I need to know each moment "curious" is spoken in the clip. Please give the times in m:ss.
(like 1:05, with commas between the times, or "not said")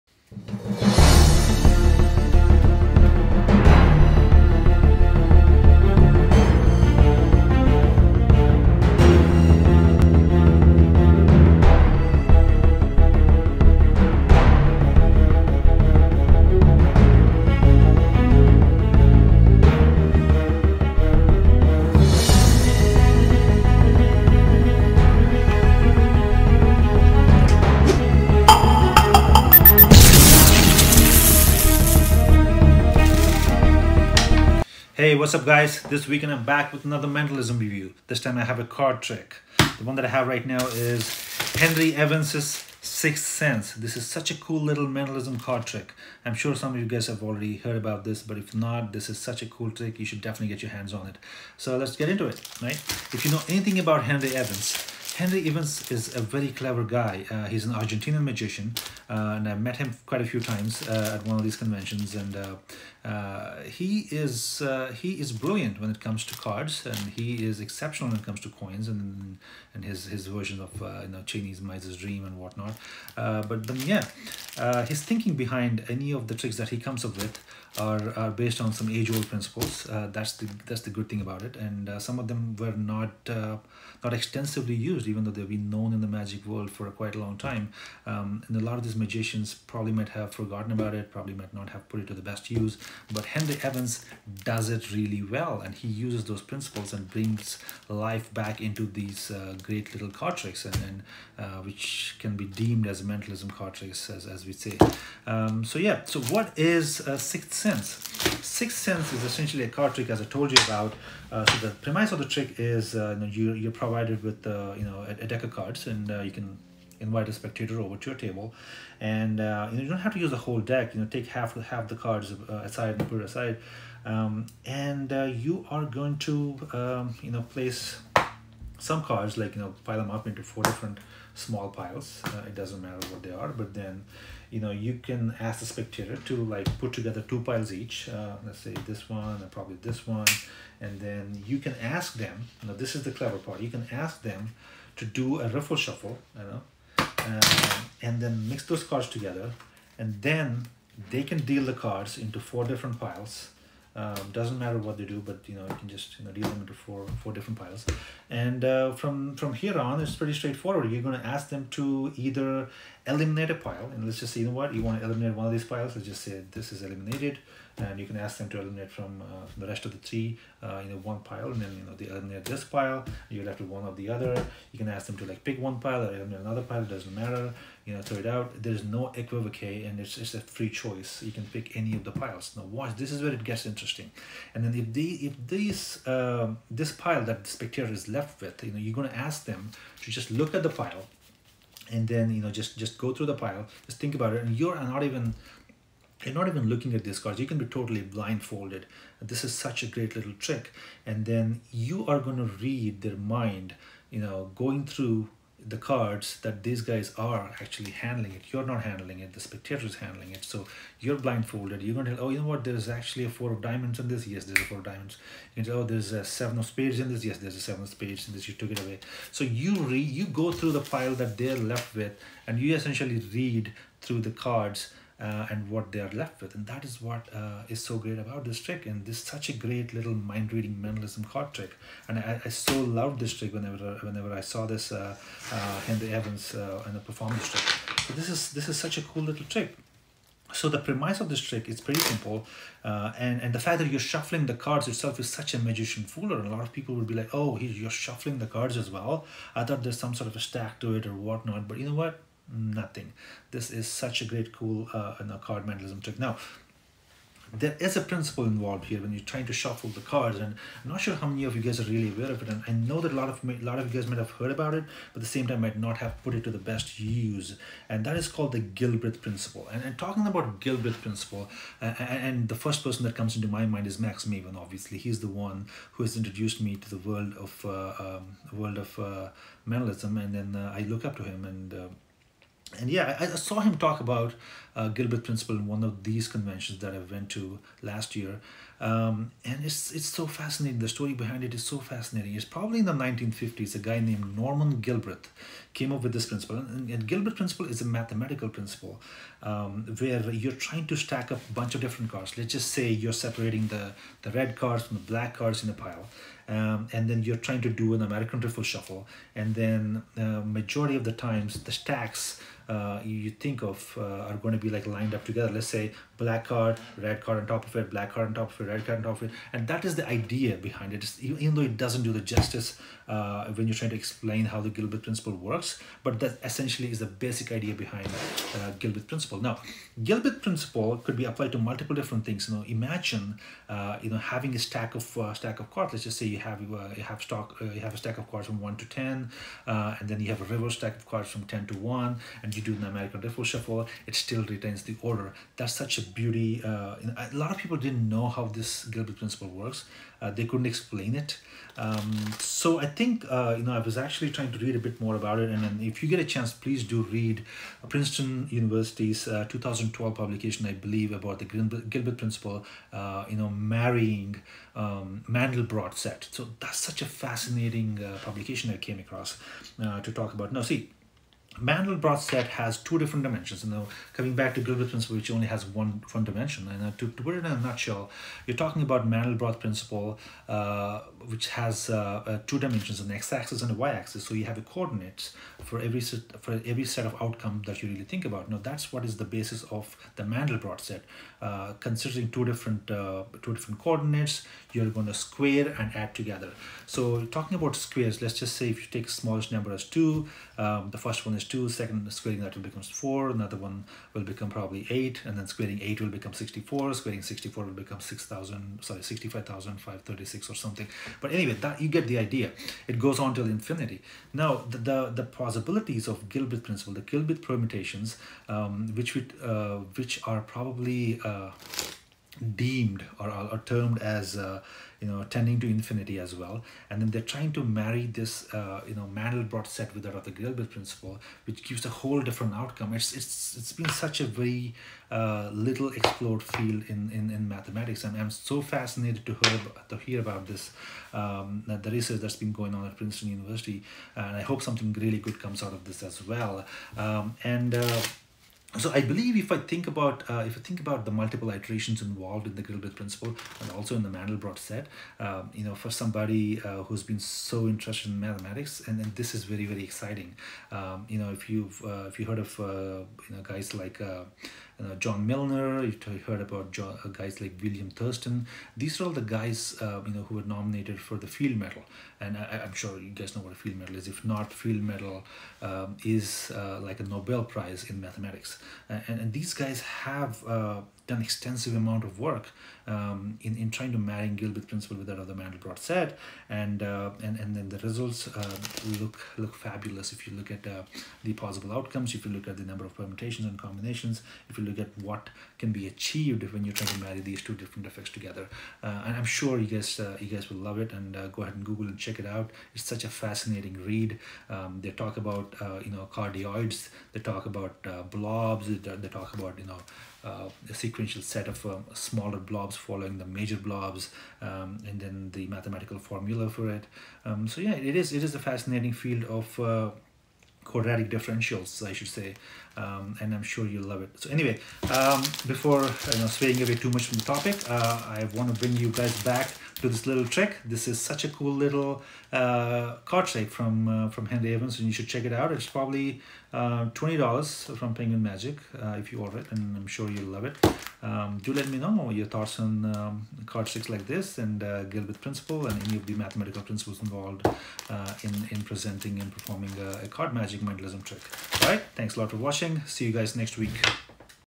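not said.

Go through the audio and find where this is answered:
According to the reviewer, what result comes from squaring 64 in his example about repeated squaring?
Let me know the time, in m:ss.
6:49.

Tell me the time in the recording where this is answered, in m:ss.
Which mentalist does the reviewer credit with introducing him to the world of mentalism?
4:33.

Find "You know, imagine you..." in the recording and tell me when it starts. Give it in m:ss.
5:32.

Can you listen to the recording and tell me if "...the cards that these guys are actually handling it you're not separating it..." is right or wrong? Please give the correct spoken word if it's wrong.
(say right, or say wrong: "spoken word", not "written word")
wrong: "handling", not "separating".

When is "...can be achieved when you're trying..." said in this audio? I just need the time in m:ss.
8:15.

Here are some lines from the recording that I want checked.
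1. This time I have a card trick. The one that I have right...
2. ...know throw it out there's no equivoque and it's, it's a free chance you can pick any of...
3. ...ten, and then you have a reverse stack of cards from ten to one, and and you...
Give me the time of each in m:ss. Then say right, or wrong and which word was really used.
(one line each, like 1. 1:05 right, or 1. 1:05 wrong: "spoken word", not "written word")
1. 0:38 right
2. 2:57 wrong: "choice", not "chance"
3. 5:38 right.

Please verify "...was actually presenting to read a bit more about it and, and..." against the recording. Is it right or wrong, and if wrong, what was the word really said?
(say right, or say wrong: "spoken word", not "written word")
wrong: "trying", not "presenting".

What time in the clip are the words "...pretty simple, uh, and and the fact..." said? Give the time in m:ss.
4:01.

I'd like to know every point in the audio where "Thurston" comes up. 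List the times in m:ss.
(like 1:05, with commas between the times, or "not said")
7:47.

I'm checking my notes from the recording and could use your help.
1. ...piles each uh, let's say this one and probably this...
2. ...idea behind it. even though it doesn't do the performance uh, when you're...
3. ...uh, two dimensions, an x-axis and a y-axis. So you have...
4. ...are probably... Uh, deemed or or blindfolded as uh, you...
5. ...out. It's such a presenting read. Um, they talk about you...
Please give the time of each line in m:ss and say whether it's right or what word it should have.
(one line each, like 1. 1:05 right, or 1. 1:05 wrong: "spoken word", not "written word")
1. 2:17 right
2. 5:20 wrong: "justice", not "performance"
3. 6:22 right
4. 7:00 wrong: "termed", not "blindfolded"
5. 8:22 wrong: "fascinating", not "presenting".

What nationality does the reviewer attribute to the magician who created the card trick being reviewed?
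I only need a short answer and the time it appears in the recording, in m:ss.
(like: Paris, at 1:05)
Argentinian, at 0:57.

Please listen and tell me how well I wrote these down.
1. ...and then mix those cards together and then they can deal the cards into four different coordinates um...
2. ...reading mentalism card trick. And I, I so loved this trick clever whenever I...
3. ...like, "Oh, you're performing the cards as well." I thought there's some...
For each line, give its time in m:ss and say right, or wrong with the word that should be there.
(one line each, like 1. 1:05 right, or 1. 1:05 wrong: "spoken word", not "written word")
1. 2:28 wrong: "piles", not "coordinates"
2. 3:50 wrong: "whenever", not "clever"
3. 4:07 wrong: "shuffling", not "performing".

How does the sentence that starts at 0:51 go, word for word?
So let's get into it, right?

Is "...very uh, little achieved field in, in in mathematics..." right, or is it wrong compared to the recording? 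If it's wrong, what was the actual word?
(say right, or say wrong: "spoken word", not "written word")
wrong: "explored", not "achieved".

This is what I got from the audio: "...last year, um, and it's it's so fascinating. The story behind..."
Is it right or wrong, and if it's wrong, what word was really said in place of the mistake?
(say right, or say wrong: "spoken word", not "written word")
right.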